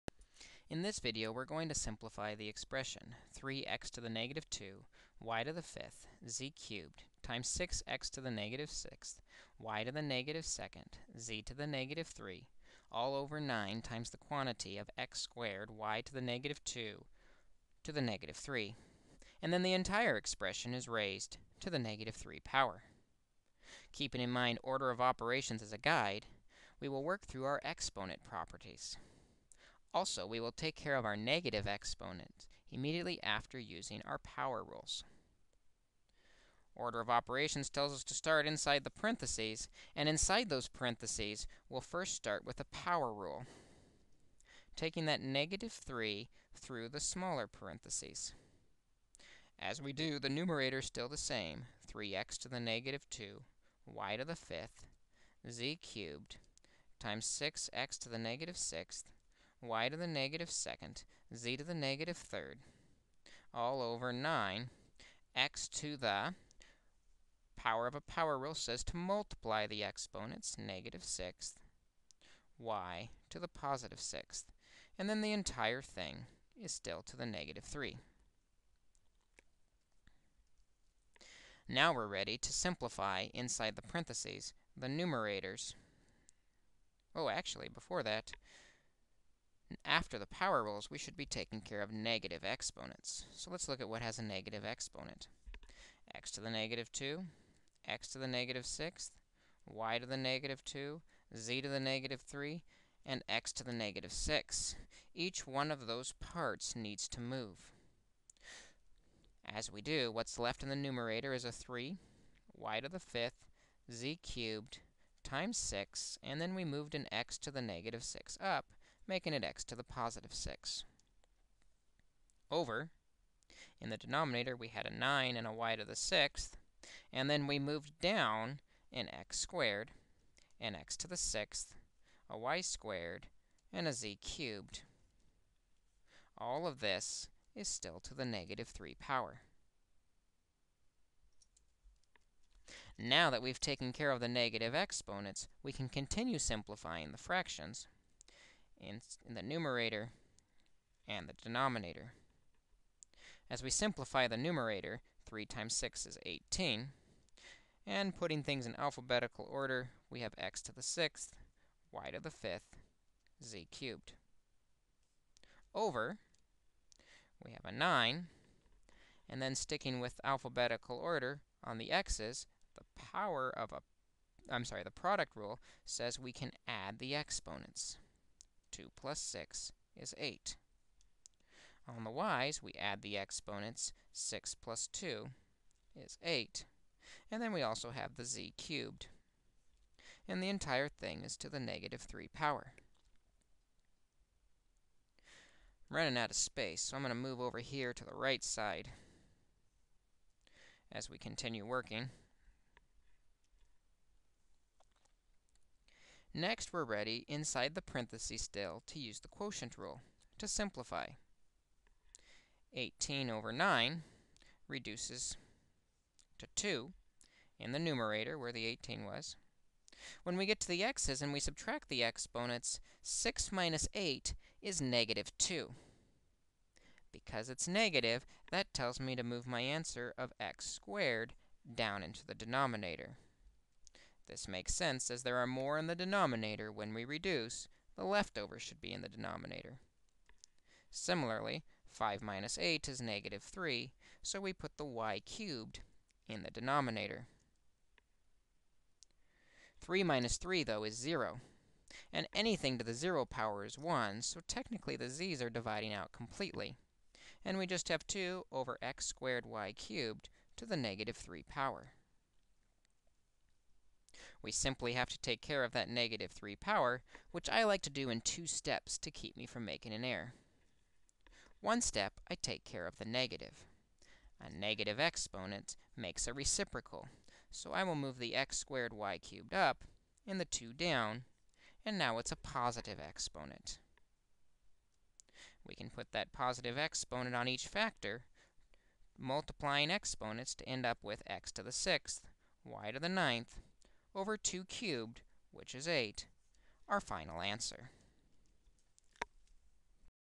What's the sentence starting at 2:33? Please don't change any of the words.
As we simplify the numerator, 3 times 6 is 18.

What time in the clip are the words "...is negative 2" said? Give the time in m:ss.
3:44.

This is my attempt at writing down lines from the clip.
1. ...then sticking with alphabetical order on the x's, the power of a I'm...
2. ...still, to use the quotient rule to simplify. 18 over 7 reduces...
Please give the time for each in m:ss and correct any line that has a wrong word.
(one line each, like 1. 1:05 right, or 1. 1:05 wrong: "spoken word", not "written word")
1. 2:49 right
2. 3:28 wrong: "9", not "7".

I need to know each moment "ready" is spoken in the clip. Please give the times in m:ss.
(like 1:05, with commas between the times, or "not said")
1:22, 3:26.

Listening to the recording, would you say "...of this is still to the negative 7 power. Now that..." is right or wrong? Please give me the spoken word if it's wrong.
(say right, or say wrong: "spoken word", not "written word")
wrong: "3", not "7".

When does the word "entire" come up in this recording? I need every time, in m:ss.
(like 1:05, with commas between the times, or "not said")
0:19, 1:15, 3:10.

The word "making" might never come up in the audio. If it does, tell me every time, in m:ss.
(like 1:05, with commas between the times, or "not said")
1:59, 4:29.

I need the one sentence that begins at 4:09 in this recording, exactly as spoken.
3 minus 3, though, is 0, and anything to the 0 power is 1, so technically the z's are dividing out completely.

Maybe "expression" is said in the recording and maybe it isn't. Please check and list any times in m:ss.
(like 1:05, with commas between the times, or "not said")
0:02, 0:20.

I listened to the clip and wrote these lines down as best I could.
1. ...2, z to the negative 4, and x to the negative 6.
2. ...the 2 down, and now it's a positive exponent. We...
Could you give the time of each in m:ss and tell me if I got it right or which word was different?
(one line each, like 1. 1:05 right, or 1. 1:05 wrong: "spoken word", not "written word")
1. 1:40 wrong: "3", not "4"
2. 4:40 right.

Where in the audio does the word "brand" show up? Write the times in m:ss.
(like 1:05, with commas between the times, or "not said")
not said.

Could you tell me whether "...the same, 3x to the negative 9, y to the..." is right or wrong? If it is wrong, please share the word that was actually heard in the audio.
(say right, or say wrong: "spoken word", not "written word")
wrong: "2", not "9".